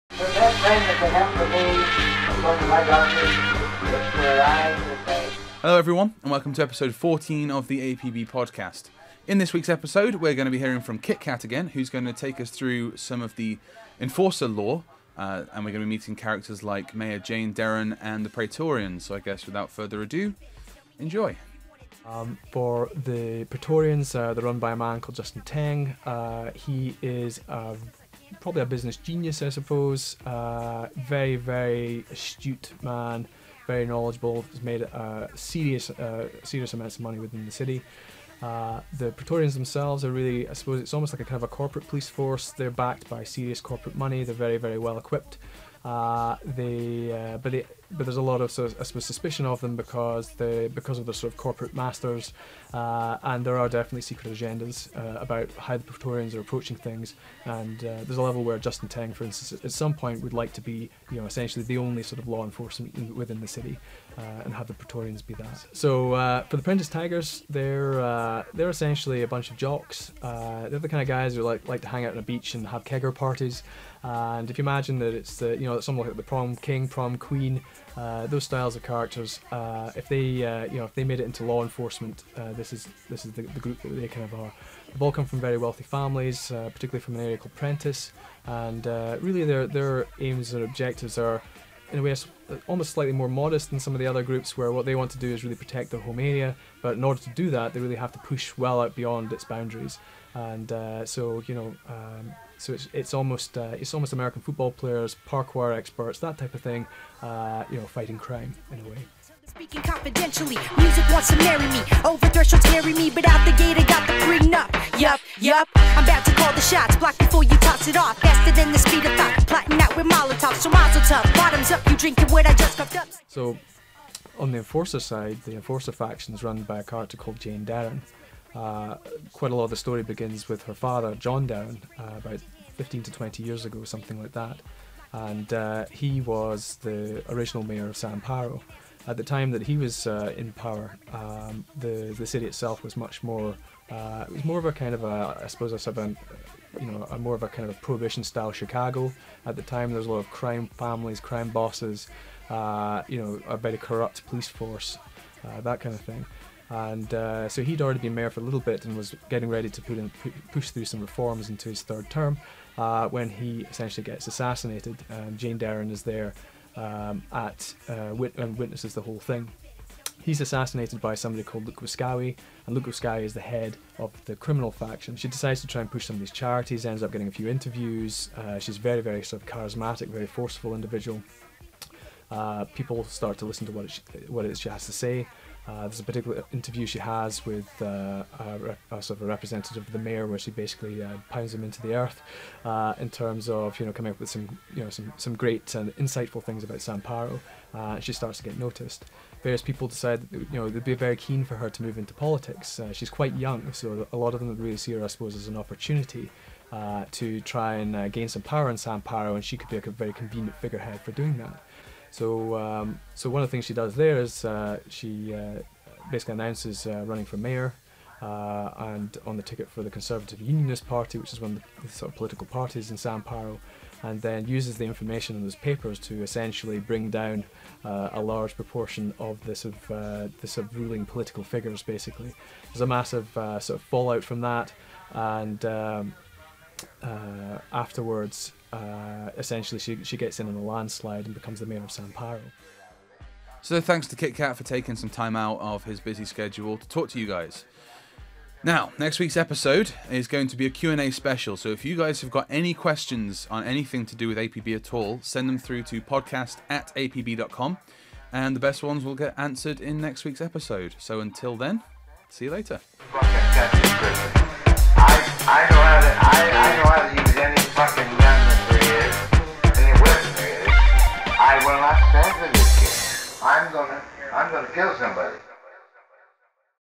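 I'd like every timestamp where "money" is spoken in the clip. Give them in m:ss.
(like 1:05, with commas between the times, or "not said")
0:37, 0:43.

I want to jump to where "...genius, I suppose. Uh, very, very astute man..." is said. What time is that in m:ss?
0:28.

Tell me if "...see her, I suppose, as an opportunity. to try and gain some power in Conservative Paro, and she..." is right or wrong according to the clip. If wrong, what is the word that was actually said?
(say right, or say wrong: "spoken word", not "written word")
wrong: "San", not "Conservative".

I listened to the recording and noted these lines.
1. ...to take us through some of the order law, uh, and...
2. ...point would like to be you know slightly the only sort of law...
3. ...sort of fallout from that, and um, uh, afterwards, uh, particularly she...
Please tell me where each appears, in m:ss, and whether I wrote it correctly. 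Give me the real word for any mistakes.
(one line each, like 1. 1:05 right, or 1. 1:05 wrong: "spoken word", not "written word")
1. 0:12 wrong: "enforcer", not "order"
2. 0:59 wrong: "essentially", not "slightly"
3. 3:53 wrong: "essentially", not "particularly".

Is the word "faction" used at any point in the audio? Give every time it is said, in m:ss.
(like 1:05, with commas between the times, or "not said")
2:05, 2:54.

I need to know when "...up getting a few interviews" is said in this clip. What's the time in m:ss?
2:57.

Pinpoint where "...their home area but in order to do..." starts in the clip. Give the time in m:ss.
1:35.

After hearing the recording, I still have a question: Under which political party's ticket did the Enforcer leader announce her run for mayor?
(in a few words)
Conservative Unionist Party.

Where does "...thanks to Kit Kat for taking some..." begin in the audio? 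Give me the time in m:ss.
4:03.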